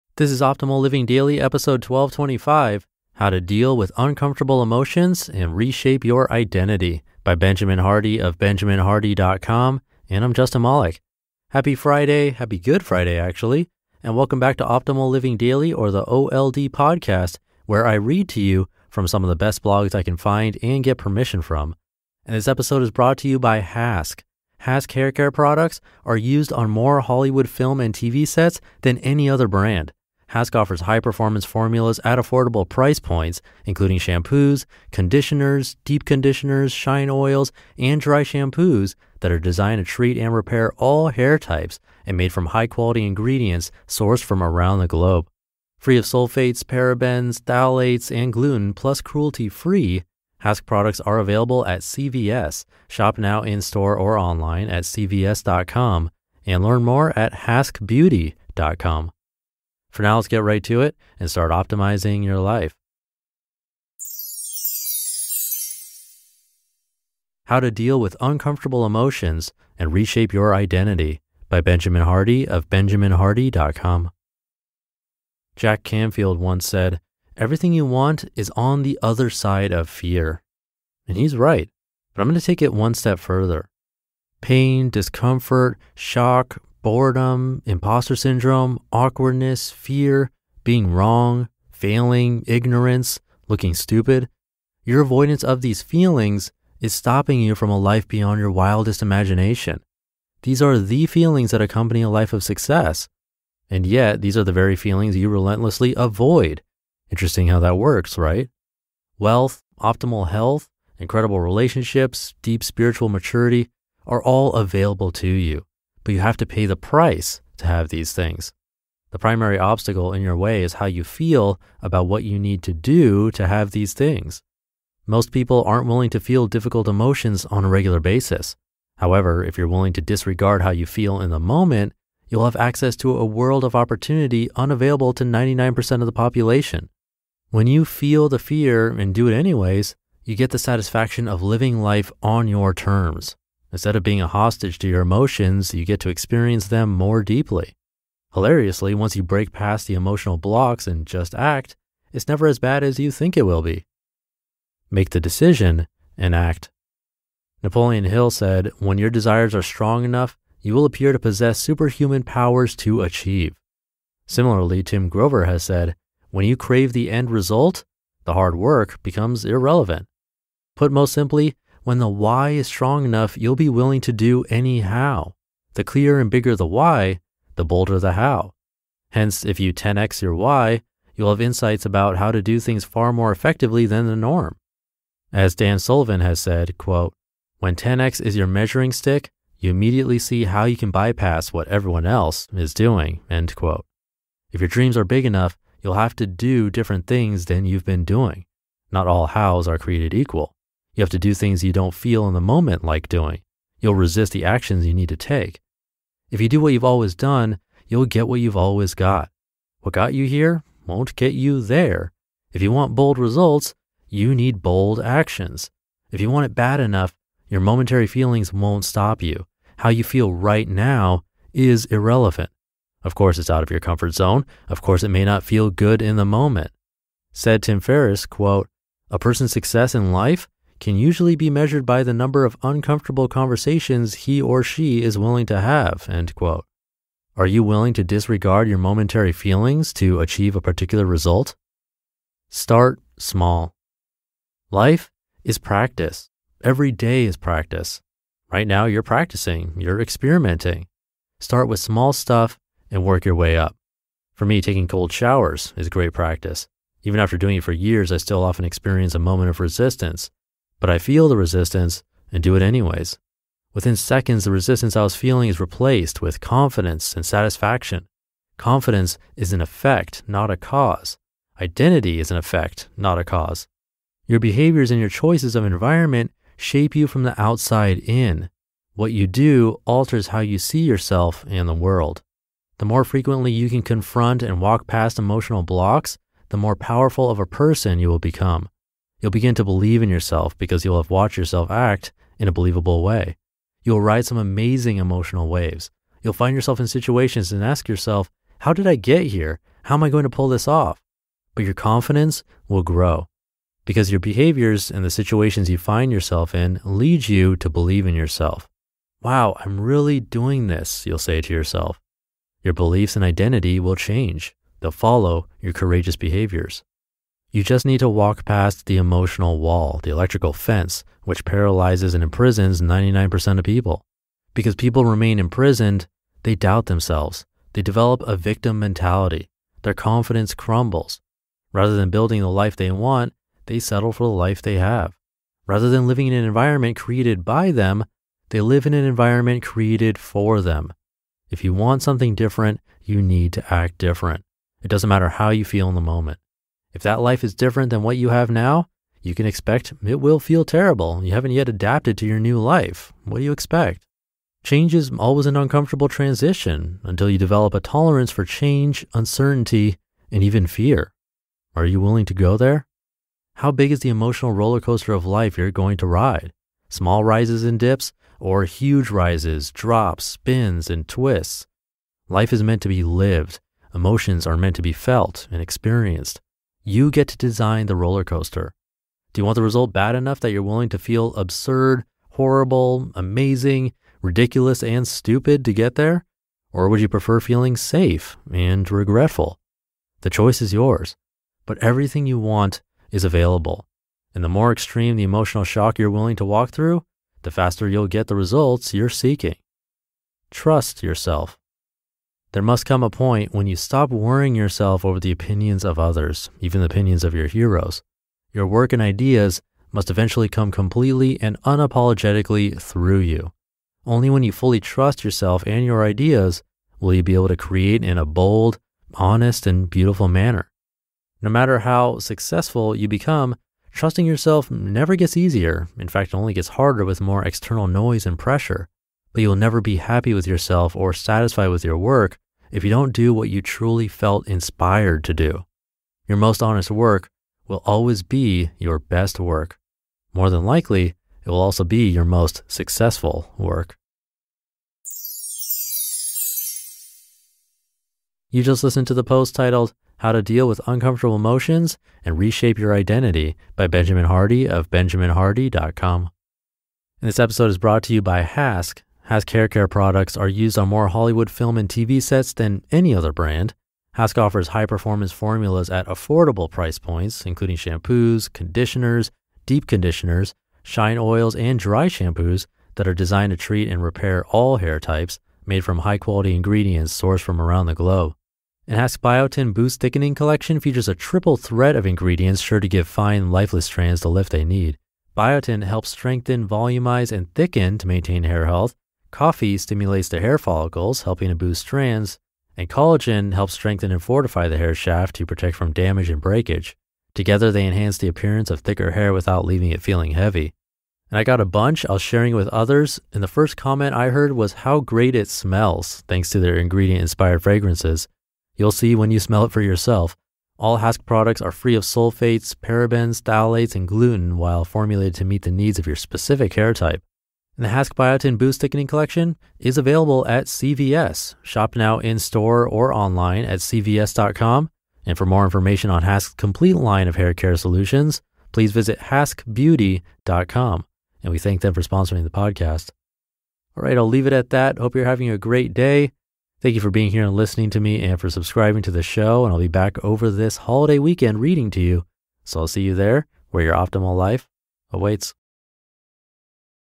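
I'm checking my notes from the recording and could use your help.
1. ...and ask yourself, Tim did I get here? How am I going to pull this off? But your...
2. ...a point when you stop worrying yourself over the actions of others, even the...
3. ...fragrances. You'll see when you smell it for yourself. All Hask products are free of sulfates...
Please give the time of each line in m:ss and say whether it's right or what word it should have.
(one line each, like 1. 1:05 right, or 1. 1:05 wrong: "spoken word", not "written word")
1. 4:57 wrong: "How", not "Tim"
2. 6:43 wrong: "opinions", not "actions"
3. 8:27 right.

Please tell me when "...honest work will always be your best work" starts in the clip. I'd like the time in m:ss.
7:16.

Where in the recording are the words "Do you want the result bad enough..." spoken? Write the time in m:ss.
6:19.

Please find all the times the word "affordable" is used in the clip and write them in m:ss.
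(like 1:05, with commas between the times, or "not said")
0:32, 7:46.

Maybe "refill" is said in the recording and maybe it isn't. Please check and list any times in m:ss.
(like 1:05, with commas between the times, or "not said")
not said.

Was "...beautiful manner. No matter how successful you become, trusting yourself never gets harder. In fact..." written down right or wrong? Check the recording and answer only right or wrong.
wrong.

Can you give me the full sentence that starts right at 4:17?
Even after doing it for years, I still often experience a moment of resistance.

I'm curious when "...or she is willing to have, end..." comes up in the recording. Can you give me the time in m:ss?
3:54.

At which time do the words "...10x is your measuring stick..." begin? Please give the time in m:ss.
3:07.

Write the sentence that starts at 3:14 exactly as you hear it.
If your dreams are big enough, you'll have to do different things than you've been doing.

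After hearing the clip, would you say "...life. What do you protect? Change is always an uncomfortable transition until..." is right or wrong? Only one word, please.
wrong.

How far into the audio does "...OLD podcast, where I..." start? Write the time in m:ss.
0:16.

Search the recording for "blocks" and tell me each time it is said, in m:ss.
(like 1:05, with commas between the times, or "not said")
2:30, 4:45.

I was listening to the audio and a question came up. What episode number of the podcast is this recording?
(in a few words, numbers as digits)
1225.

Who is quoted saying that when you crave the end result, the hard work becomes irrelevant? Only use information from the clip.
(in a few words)
Tim Grover.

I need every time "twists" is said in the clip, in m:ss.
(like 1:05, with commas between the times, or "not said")
6:11.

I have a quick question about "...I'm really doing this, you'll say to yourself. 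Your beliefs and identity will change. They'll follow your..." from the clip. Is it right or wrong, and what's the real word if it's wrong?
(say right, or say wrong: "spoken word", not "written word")
right.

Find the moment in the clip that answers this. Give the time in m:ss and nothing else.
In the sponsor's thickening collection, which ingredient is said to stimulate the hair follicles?
8:09.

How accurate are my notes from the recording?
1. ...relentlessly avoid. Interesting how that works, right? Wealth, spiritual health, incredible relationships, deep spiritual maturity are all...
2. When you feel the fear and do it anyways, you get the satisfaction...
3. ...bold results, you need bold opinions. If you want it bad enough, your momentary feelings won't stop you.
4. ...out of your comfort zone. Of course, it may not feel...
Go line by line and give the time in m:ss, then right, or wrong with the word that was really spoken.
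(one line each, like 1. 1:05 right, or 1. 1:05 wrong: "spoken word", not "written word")
1. 1:45 wrong: "optimal", not "spiritual"
2. 2:17 right
3. 3:32 wrong: "actions", not "opinions"
4. 3:43 right.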